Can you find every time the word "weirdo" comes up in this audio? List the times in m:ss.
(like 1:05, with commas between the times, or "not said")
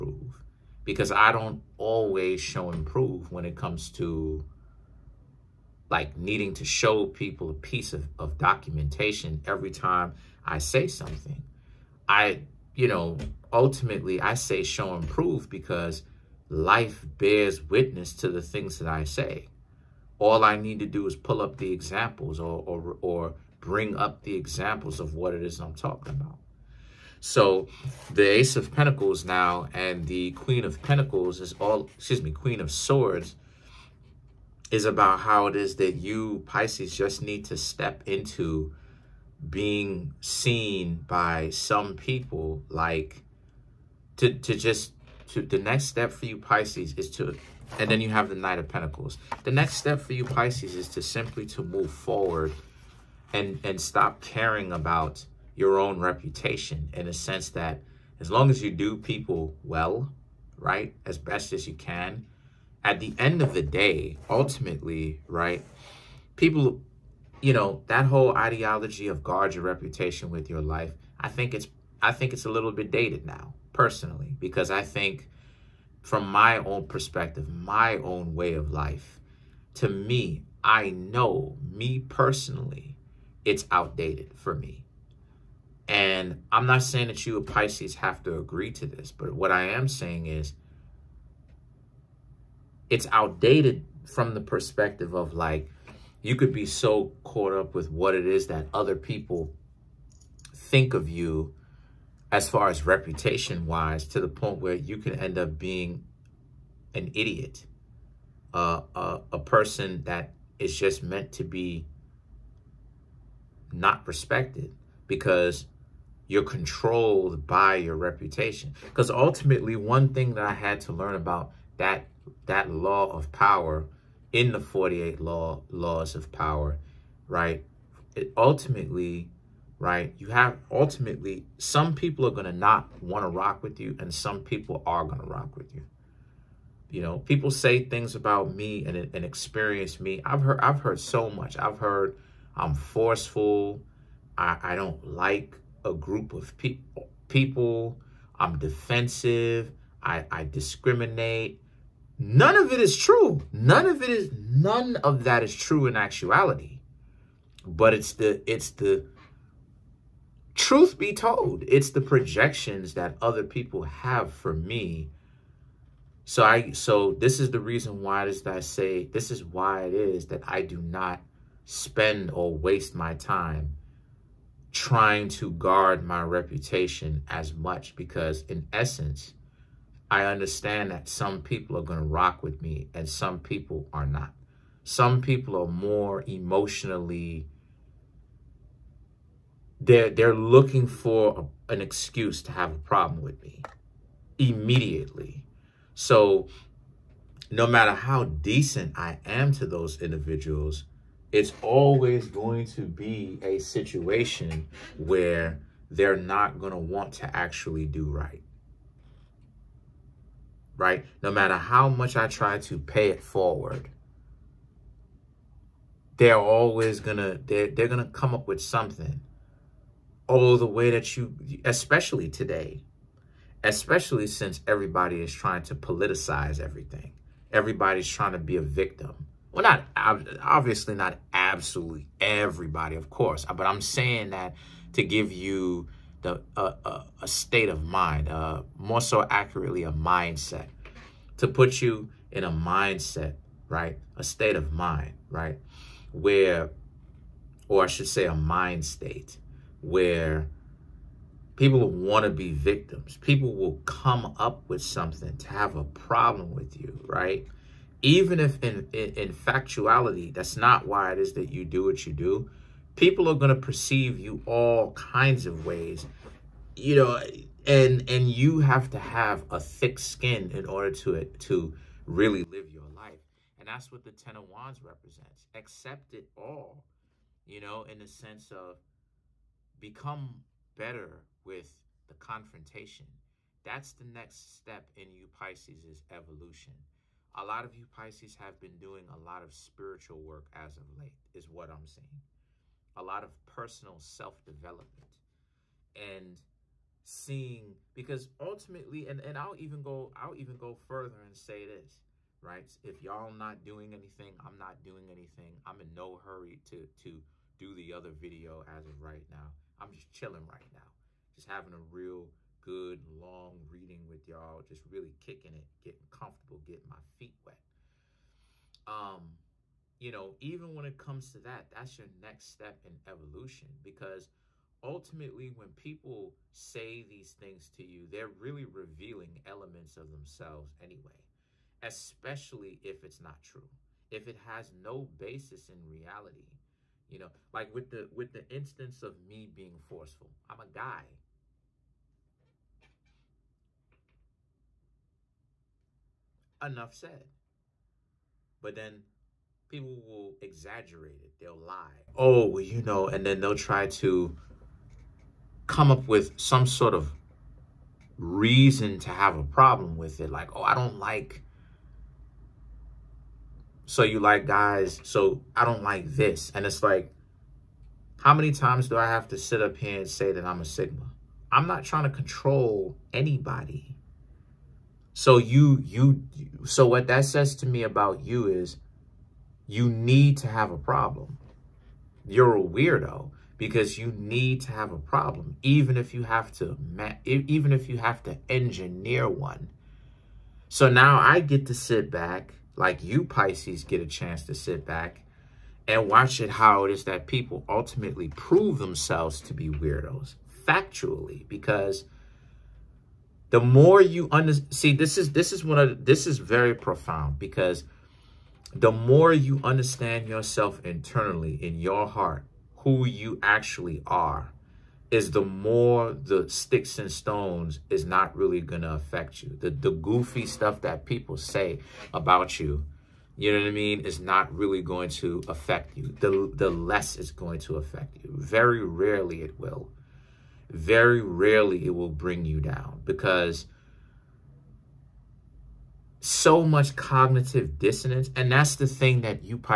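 6:22, 6:39.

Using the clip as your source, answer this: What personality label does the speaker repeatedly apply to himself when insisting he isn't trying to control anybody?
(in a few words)
Sigma.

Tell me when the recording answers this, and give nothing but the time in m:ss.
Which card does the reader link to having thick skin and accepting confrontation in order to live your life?
4:34.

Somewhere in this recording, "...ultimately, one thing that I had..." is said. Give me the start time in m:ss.
1:59.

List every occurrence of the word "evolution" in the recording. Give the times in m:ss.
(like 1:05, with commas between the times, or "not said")
4:46, 5:23.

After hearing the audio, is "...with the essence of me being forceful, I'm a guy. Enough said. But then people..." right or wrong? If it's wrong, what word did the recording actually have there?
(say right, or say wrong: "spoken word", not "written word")
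wrong: "instance", not "essence".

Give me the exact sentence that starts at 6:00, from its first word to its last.
Like, oh, I don't like so you like guys, so I don't like this.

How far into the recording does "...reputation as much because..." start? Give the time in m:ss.
2:56.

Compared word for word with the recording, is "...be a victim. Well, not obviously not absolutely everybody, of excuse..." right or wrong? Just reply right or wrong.
wrong.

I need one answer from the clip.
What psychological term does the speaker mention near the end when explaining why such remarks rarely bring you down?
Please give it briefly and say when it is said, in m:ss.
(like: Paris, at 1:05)
cognitive dissonance, at 7:16.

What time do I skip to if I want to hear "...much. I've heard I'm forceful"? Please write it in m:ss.
2:21.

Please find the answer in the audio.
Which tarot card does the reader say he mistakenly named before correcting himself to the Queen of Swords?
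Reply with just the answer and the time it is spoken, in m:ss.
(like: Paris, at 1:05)
Queen of Pentacles, at 0:30.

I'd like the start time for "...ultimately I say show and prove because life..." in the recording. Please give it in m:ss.
0:13.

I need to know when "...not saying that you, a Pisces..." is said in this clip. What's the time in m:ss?
1:26.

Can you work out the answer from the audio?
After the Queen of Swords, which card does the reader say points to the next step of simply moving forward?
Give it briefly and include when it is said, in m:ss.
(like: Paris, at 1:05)
Knight of Pentacles, at 0:48.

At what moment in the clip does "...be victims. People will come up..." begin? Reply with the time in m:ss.
4:12.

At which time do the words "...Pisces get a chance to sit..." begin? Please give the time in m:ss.
6:33.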